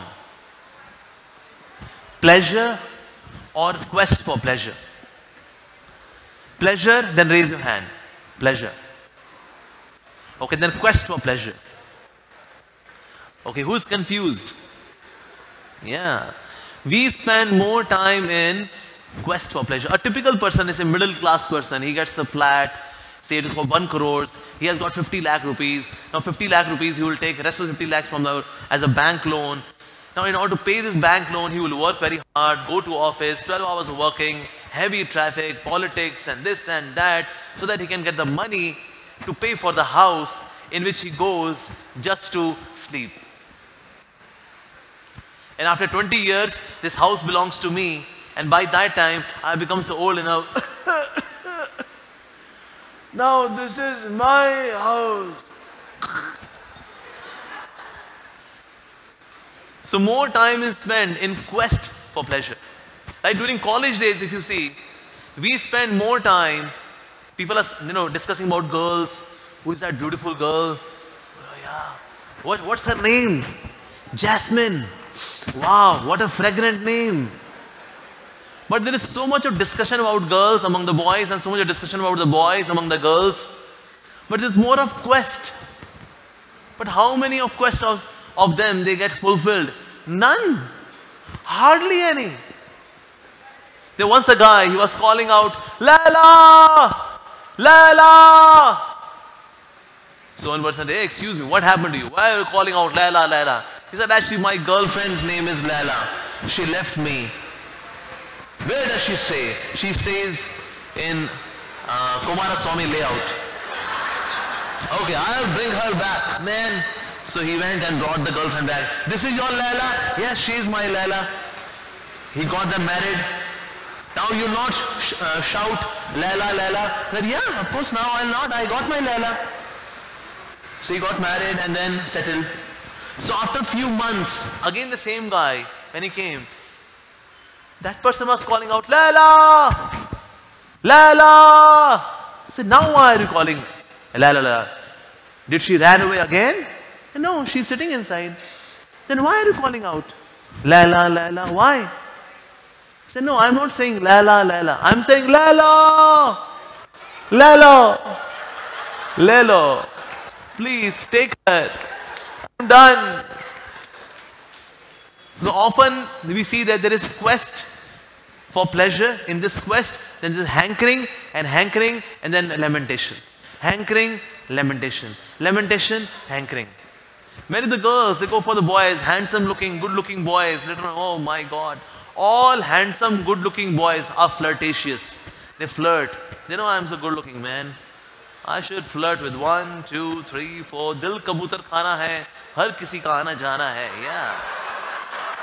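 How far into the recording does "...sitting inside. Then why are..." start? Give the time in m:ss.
2:27.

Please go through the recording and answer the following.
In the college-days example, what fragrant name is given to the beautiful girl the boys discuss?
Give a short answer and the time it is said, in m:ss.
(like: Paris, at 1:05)
Jasmine, at 1:14.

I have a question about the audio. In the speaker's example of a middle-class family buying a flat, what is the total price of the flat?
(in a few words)
1 crore.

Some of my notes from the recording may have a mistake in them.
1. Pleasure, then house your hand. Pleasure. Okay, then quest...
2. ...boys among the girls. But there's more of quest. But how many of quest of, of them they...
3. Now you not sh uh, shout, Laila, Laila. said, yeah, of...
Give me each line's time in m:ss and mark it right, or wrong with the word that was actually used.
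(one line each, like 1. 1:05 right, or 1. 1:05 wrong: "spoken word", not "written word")
1. 0:06 wrong: "raise", not "house"
2. 1:22 right
3. 2:04 right.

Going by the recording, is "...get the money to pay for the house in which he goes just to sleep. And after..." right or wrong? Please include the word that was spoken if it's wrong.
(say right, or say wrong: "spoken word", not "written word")
right.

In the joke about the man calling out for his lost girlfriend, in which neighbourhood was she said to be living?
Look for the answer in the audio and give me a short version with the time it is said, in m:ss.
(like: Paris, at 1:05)
Kumaraswamy layout, at 1:52.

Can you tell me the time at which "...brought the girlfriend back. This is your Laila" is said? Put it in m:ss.
1:57.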